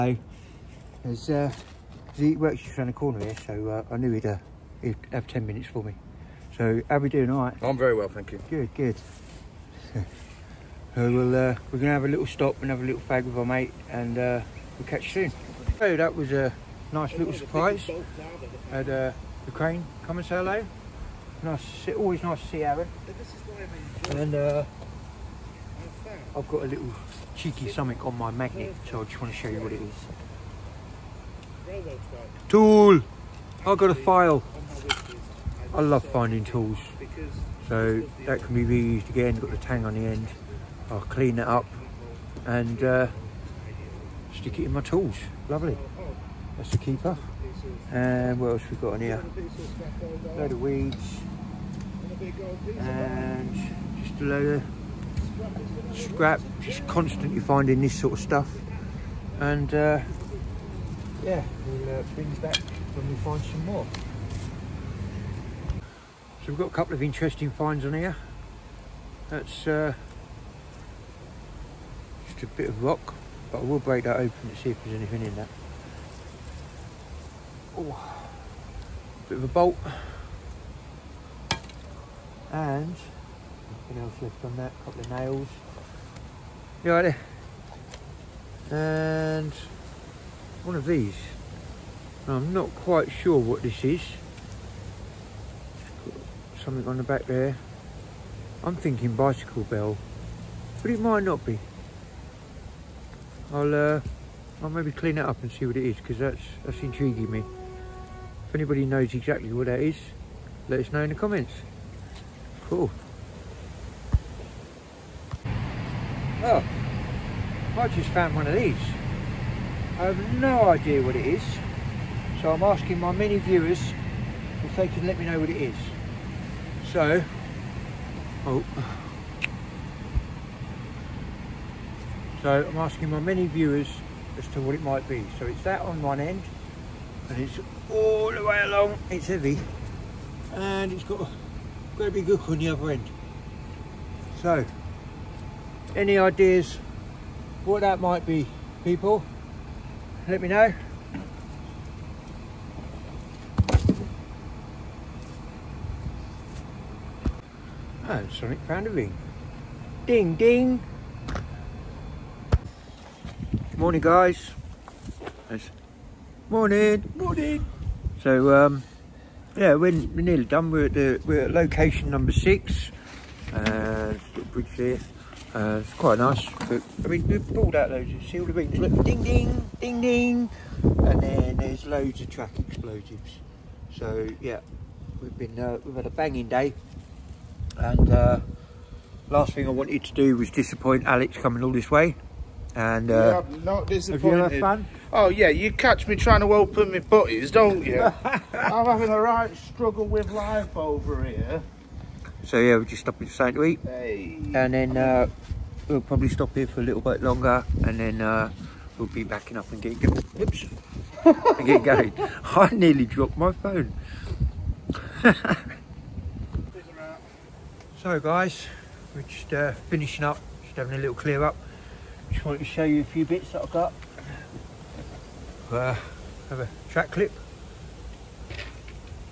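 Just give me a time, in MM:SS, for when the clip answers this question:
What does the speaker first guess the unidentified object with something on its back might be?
01:39.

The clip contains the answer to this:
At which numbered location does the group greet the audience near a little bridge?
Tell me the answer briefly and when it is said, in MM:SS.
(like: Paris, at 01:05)
6, at 02:51.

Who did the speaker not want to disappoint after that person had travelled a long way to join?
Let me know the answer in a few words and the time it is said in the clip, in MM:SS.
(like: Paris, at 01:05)
Alex, at 03:11.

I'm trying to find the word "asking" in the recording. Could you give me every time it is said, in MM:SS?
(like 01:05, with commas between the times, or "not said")
02:02, 02:12.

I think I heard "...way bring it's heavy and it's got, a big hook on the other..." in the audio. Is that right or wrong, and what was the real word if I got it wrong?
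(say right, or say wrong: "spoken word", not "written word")
wrong: "along", not "bring".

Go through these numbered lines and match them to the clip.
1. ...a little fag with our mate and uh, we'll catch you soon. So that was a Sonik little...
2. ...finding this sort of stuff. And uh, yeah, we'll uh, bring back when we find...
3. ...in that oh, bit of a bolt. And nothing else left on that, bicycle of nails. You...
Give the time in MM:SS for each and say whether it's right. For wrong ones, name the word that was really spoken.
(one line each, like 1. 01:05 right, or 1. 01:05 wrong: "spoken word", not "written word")
1. 00:12 wrong: "Nice", not "Sonik"
2. 00:57 right
3. 01:15 wrong: "couple", not "bicycle".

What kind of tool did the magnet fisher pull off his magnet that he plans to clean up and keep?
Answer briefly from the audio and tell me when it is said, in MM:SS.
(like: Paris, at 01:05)
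A file, at 00:33.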